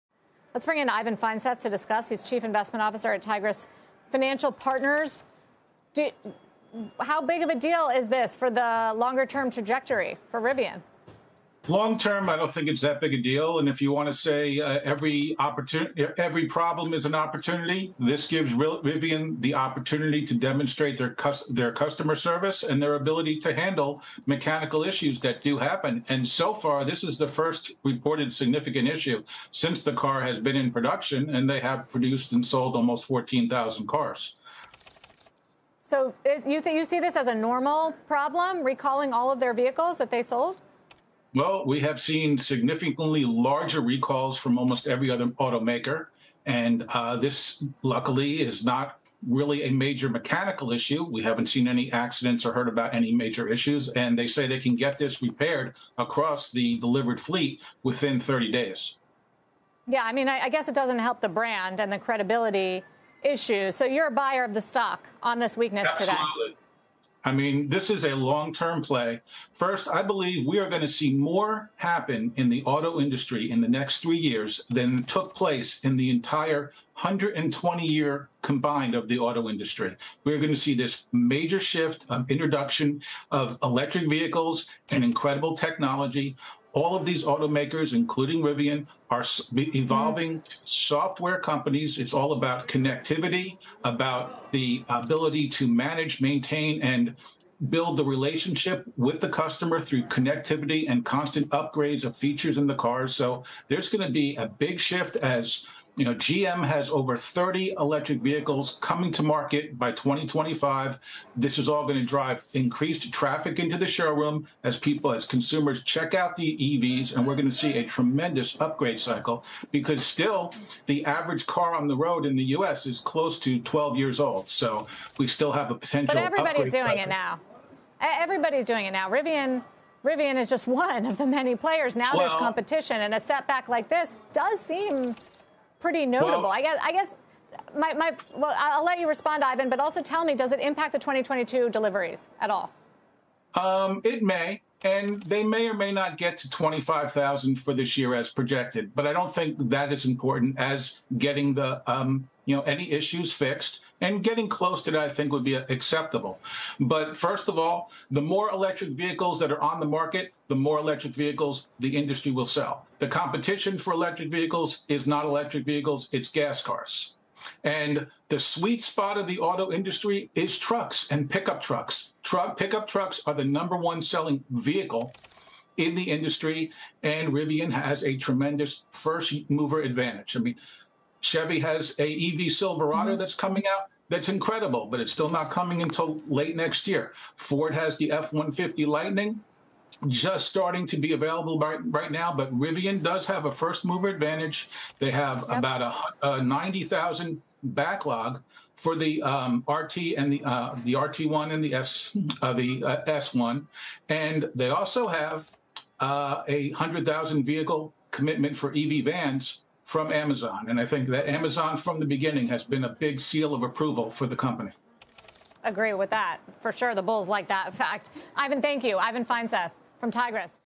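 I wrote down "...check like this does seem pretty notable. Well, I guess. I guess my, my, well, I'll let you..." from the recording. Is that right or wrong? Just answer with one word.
wrong.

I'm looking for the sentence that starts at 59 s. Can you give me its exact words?
Yeah, I mean, I, I guess it doesn't help the brand and the credibility issue.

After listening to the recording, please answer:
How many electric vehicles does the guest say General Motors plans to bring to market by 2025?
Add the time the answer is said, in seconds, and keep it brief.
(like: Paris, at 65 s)
over 30, at 106 s.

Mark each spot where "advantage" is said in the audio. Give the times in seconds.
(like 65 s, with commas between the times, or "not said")
179 s, 194 s.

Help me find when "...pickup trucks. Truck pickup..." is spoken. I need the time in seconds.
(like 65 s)
171 s.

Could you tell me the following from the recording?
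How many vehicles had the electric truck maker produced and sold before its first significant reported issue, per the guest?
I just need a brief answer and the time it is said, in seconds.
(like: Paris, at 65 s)
14,000, at 32 s.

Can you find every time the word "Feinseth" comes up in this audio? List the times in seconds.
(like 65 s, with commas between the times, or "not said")
1 s, 219 s.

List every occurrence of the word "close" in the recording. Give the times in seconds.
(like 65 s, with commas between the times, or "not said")
122 s, 154 s.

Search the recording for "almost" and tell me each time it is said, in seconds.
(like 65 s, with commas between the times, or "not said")
32 s, 44 s.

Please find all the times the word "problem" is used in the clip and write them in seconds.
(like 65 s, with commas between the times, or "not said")
16 s, 38 s.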